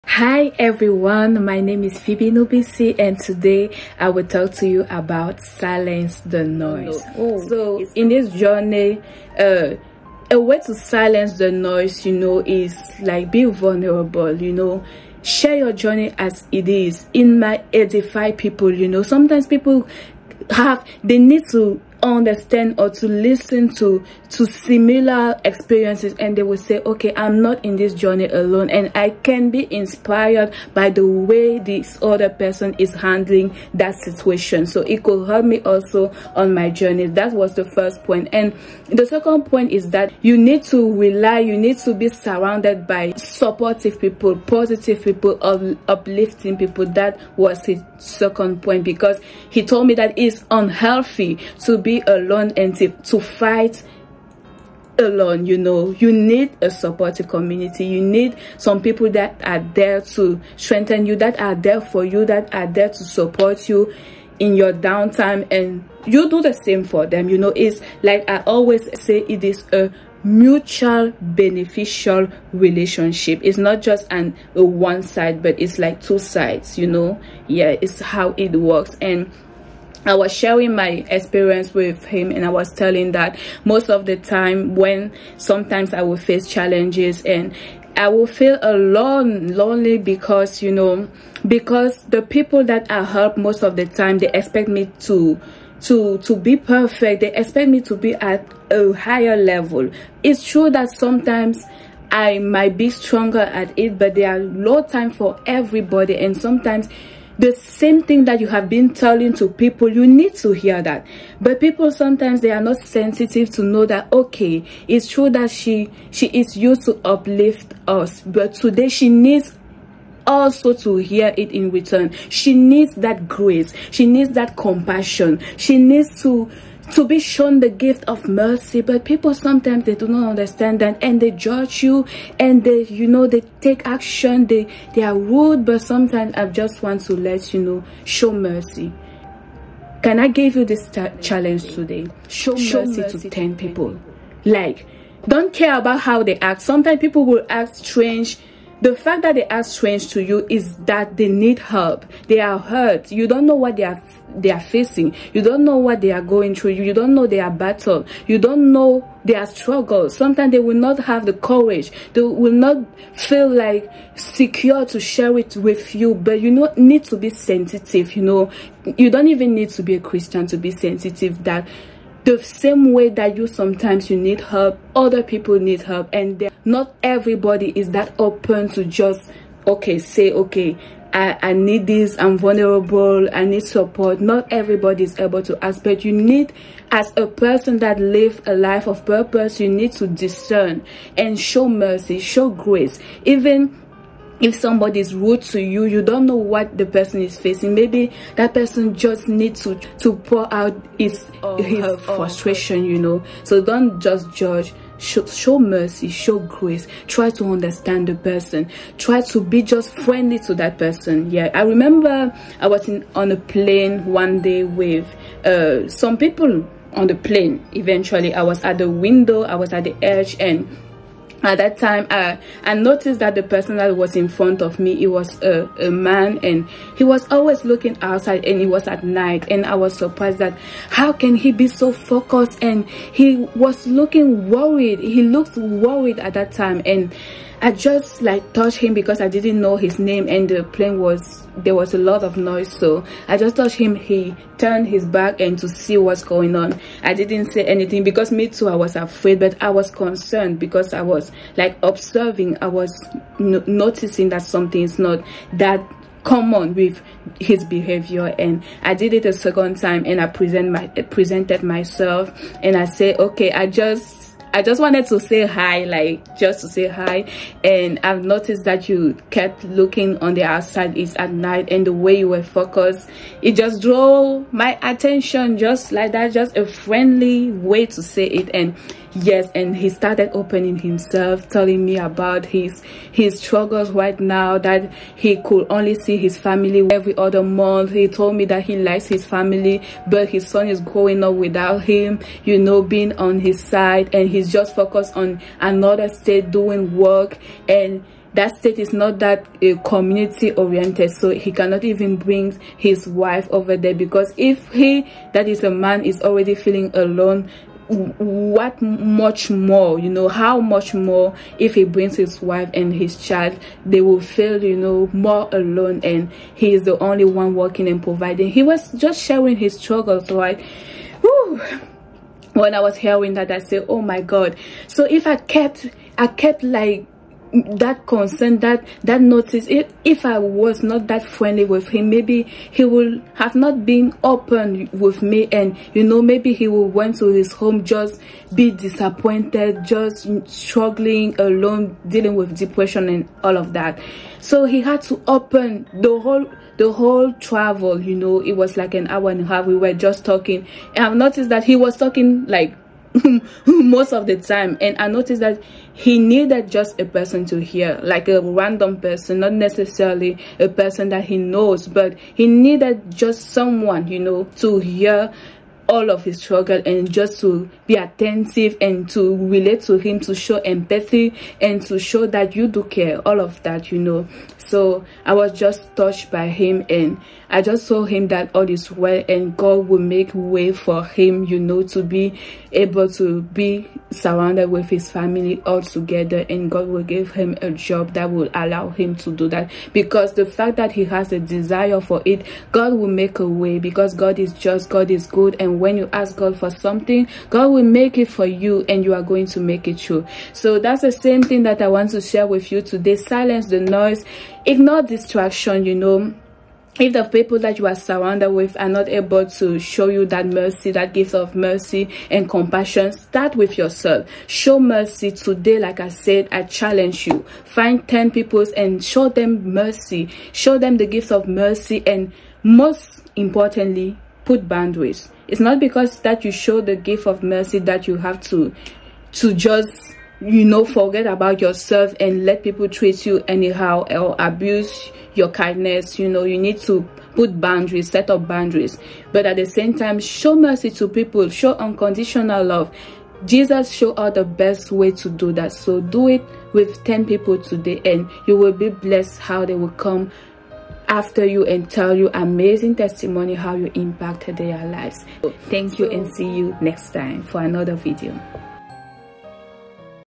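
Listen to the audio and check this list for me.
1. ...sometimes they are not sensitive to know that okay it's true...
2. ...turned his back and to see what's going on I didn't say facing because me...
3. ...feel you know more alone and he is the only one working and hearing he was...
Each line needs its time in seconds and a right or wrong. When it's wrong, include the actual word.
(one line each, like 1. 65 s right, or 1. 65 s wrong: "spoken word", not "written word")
1. 111 s right
2. 244 s wrong: "anything", not "facing"
3. 314 s wrong: "providing", not "hearing".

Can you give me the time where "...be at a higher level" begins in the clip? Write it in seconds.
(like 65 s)
97 s.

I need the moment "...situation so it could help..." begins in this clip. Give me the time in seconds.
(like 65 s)
33 s.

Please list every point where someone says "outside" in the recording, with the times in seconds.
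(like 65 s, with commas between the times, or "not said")
228 s, 270 s.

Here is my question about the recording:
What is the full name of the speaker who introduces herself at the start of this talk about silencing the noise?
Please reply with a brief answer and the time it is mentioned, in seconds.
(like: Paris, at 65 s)
Phoebe Noubissi, at 1 s.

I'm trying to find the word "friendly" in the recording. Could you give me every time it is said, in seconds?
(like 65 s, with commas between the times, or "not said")
209 s, 276 s, 331 s.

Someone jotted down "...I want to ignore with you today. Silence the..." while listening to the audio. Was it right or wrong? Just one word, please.
wrong.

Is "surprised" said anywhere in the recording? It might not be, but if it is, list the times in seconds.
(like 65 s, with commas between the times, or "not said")
229 s.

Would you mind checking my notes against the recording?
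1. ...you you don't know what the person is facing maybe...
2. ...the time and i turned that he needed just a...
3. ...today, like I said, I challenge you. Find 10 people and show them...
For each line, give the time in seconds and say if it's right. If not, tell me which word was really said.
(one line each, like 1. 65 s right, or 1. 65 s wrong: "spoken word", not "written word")
1. 195 s right
2. 354 s wrong: "noticed", not "turned"
3. 415 s right.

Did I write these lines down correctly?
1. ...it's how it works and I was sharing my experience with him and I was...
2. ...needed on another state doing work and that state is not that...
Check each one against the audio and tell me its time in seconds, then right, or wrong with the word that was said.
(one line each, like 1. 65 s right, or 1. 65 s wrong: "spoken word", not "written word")
1. 77 s right
2. 294 s wrong: "focused", not "needed".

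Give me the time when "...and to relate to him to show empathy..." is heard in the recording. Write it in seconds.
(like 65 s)
368 s.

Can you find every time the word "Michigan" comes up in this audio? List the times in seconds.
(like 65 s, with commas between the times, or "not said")
not said.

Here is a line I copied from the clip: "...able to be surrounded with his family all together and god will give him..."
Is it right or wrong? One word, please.
right.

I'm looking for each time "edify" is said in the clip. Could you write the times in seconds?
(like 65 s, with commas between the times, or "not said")
17 s.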